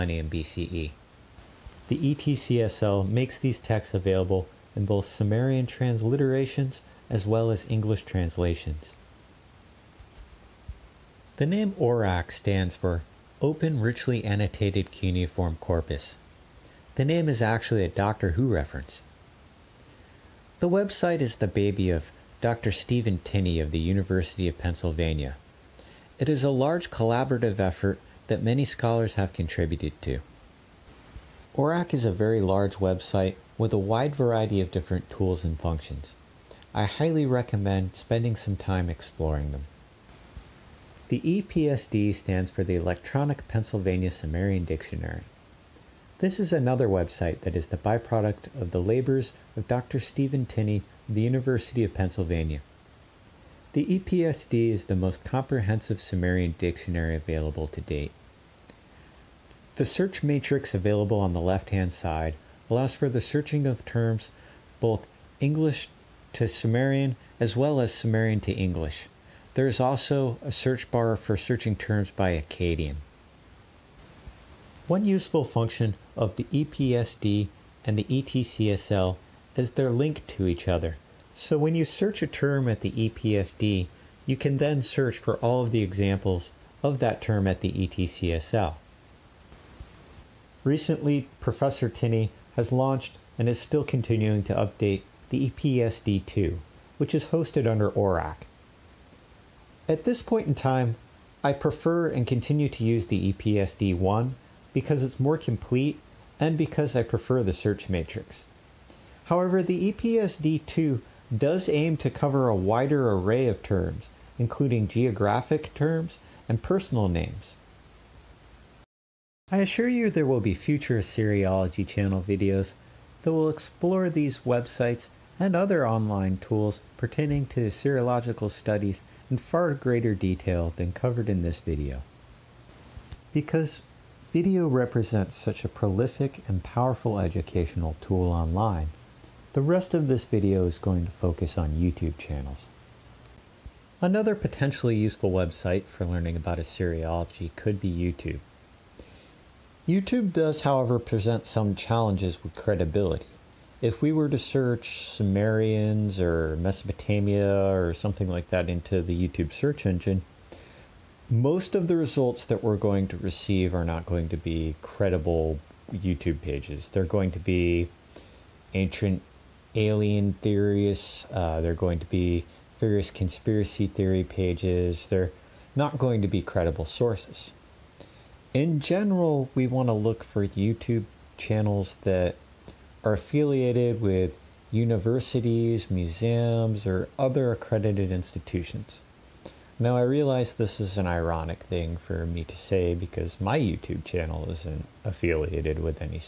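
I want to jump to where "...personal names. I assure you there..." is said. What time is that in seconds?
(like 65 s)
116 s.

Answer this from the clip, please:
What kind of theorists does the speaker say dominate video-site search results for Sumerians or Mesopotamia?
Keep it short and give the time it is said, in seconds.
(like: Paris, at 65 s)
ancient alien theorists, at 168 s.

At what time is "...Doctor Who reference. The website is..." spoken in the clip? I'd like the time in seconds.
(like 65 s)
17 s.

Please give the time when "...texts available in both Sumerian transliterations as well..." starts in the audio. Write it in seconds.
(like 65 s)
3 s.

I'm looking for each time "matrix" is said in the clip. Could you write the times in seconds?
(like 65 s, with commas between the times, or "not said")
60 s, 107 s.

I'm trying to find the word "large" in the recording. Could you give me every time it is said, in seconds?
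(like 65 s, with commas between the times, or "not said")
26 s, 32 s.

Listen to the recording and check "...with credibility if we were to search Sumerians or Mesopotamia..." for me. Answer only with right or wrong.
right.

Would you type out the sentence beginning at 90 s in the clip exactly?
Recently, Professor Tinney has launched and is still continuing to update the EPSD2, which is hosted under Oracc.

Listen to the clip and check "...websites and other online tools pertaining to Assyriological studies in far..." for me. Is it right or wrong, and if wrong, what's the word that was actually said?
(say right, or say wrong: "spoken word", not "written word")
right.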